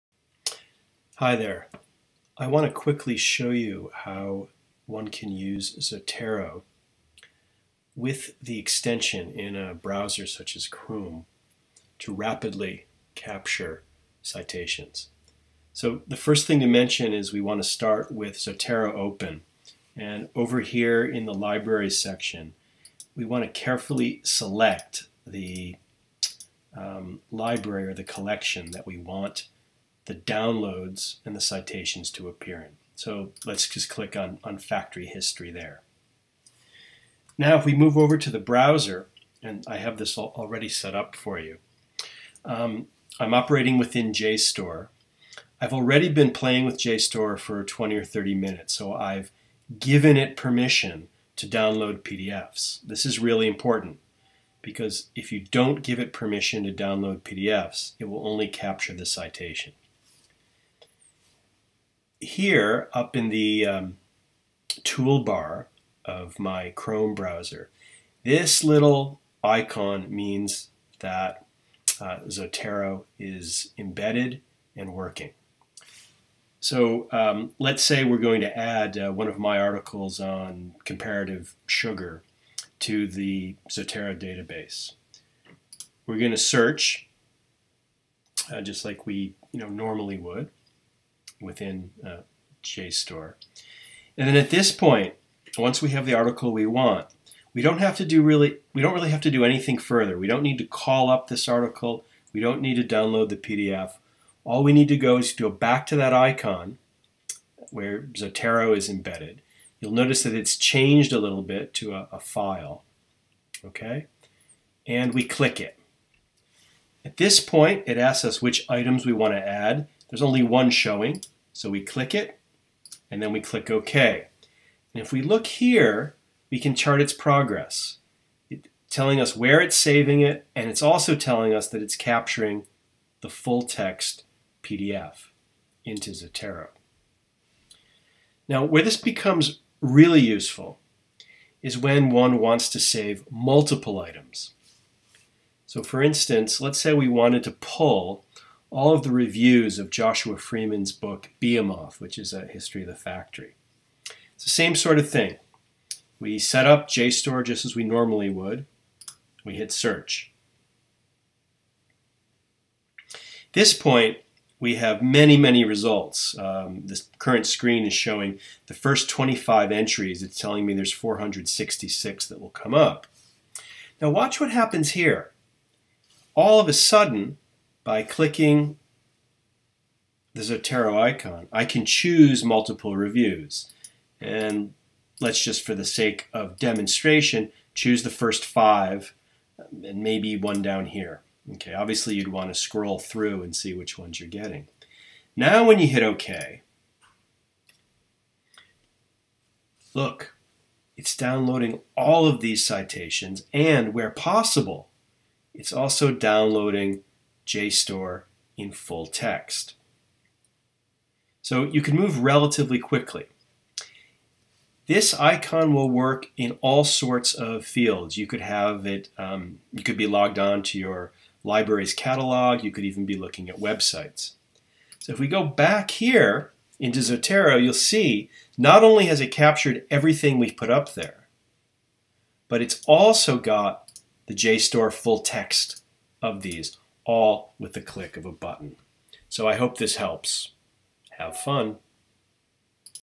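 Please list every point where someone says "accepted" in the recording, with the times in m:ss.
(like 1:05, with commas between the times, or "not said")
not said.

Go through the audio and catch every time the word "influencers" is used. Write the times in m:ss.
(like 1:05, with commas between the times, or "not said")
not said.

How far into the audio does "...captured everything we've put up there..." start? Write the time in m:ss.
3:49.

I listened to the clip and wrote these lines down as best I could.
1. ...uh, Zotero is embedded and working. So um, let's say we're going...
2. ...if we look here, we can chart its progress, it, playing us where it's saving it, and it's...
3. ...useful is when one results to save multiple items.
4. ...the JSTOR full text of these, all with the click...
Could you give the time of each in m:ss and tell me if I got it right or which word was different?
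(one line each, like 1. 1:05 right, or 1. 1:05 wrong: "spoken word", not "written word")
1. 1:11 right
2. 2:05 wrong: "telling", not "playing"
3. 2:20 wrong: "wants", not "results"
4. 3:54 right.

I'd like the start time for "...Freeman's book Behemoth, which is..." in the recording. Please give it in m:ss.
2:30.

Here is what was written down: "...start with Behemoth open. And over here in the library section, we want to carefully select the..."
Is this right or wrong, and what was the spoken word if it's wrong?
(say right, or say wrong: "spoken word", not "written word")
wrong: "Zotero", not "Behemoth".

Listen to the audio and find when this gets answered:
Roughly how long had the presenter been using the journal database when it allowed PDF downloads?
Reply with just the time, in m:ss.
0:47.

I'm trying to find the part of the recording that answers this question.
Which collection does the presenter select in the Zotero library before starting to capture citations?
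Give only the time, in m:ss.
0:34.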